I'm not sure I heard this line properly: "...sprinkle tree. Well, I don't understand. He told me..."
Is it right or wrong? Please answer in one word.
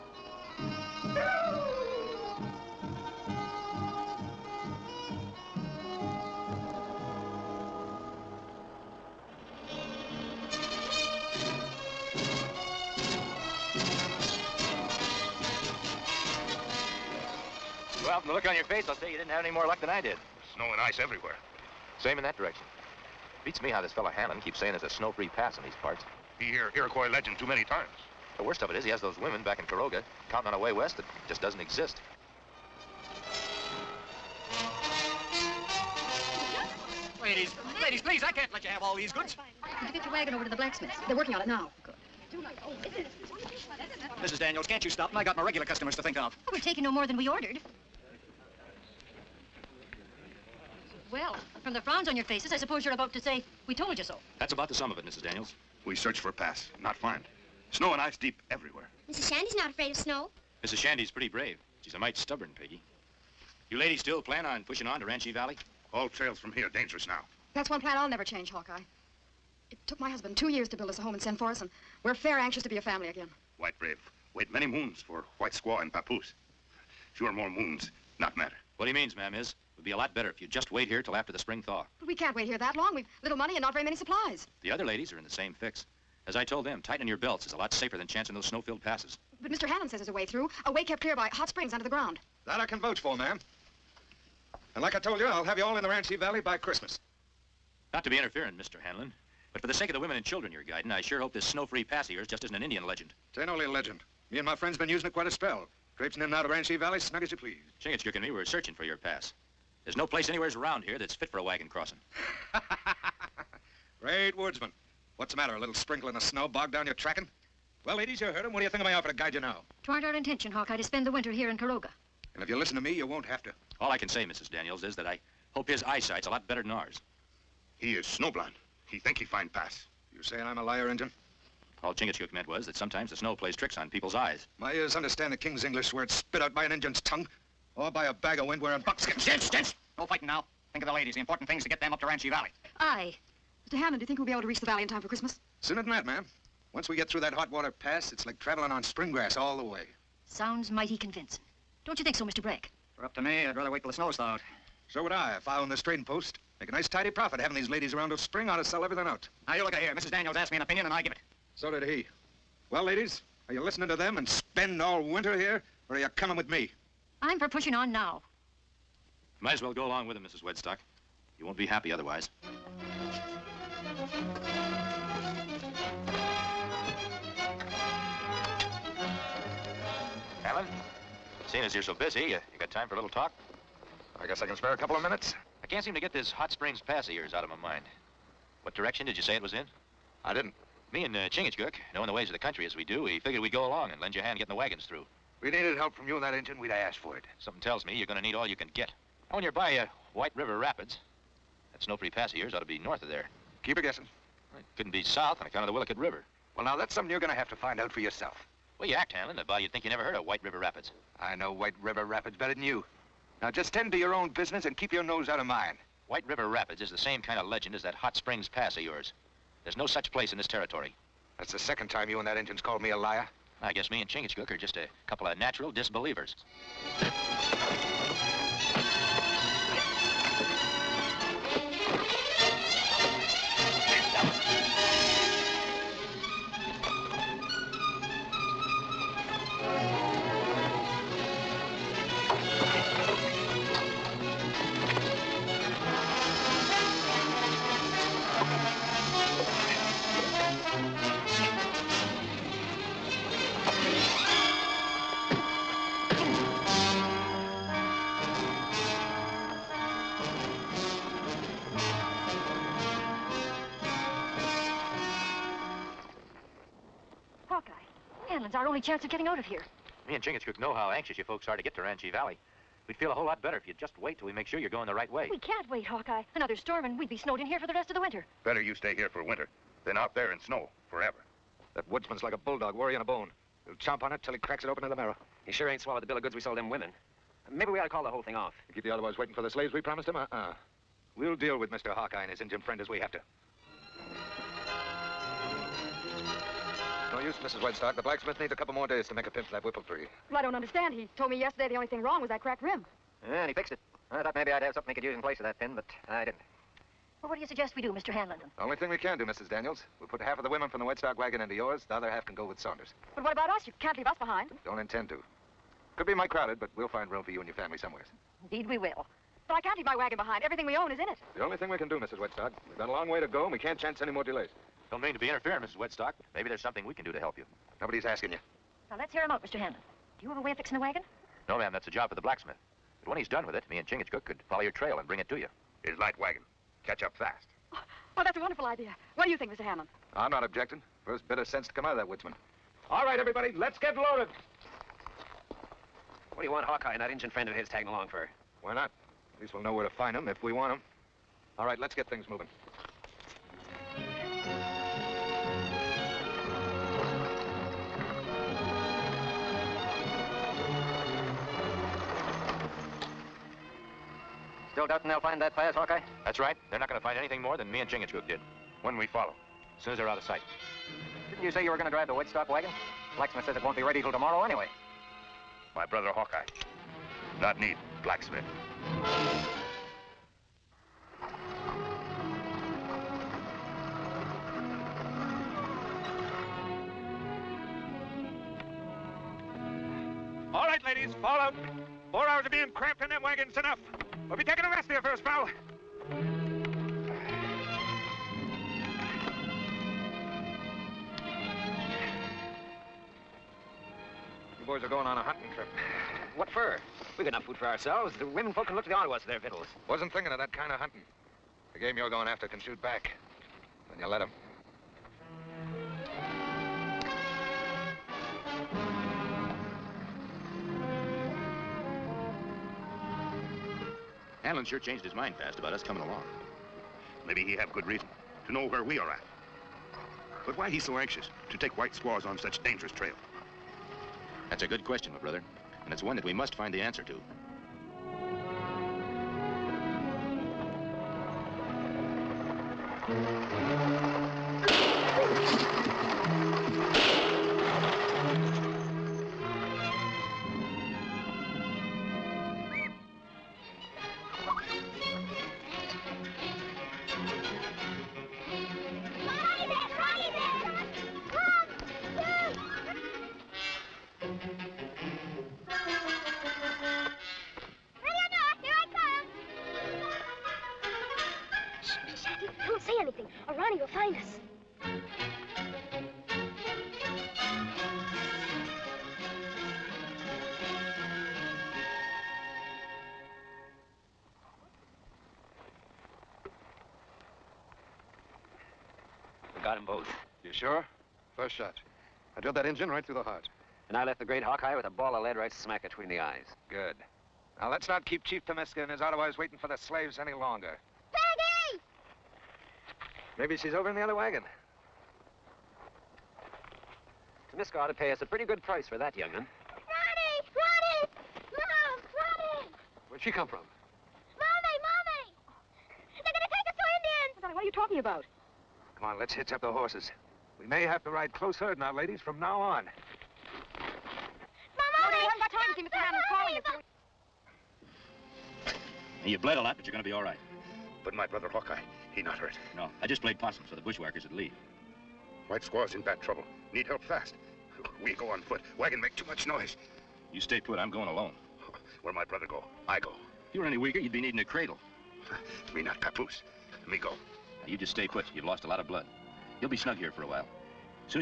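wrong.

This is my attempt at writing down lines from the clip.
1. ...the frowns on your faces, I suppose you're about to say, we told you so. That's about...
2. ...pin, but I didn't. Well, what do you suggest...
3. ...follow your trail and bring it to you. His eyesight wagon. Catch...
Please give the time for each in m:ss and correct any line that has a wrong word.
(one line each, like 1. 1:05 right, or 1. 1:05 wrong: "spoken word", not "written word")
1. 0:51 right
2. 5:05 right
3. 5:34 wrong: "light", not "eyesight".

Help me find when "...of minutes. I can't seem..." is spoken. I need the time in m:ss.
3:04.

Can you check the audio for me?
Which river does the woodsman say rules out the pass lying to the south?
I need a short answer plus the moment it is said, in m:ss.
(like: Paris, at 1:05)
Willicut River, at 3:25.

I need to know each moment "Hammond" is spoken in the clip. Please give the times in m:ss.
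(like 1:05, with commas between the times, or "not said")
2:23.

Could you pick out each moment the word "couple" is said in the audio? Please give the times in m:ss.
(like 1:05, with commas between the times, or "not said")
3:04, 3:45, 4:58.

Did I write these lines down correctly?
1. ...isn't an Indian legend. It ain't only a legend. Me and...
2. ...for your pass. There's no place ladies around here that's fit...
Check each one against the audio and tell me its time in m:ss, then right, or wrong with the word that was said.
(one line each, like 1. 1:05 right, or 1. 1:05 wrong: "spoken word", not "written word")
1. 1:42 right
2. 1:48 wrong: "anywheres", not "ladies".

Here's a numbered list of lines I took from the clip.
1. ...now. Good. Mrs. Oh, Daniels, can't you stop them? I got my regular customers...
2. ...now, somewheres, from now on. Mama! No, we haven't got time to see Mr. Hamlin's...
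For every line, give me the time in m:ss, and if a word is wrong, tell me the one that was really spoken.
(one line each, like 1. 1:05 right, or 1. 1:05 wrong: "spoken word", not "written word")
1. 0:41 right
2. 8:41 wrong: "ladies", not "somewheres".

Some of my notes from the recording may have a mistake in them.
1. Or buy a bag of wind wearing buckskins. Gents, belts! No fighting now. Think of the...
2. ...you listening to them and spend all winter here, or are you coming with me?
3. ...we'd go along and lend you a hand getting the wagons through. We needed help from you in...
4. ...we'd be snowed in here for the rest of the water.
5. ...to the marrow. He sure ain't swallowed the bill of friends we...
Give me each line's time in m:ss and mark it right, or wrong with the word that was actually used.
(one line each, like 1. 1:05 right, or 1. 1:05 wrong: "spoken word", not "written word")
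1. 2:17 wrong: "gents", not "belts"
2. 2:43 right
3. 3:13 right
4. 4:36 wrong: "winter", not "water"
5. 4:44 wrong: "goods", not "friends".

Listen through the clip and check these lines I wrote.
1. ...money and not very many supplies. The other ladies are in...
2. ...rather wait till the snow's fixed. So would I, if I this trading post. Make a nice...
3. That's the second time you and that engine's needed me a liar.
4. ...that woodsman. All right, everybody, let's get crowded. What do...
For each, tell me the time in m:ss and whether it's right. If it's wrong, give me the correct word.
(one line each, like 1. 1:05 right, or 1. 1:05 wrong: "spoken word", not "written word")
1. 1:23 right
2. 2:33 wrong: "thawed", not "fixed"
3. 3:41 wrong: "called", not "needed"
4. 5:41 wrong: "loaded", not "crowded".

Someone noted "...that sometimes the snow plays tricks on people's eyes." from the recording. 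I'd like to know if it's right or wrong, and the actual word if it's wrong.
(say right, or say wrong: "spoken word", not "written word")
right.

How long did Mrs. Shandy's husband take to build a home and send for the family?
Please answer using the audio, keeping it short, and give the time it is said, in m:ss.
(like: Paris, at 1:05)
2 years, at 1:10.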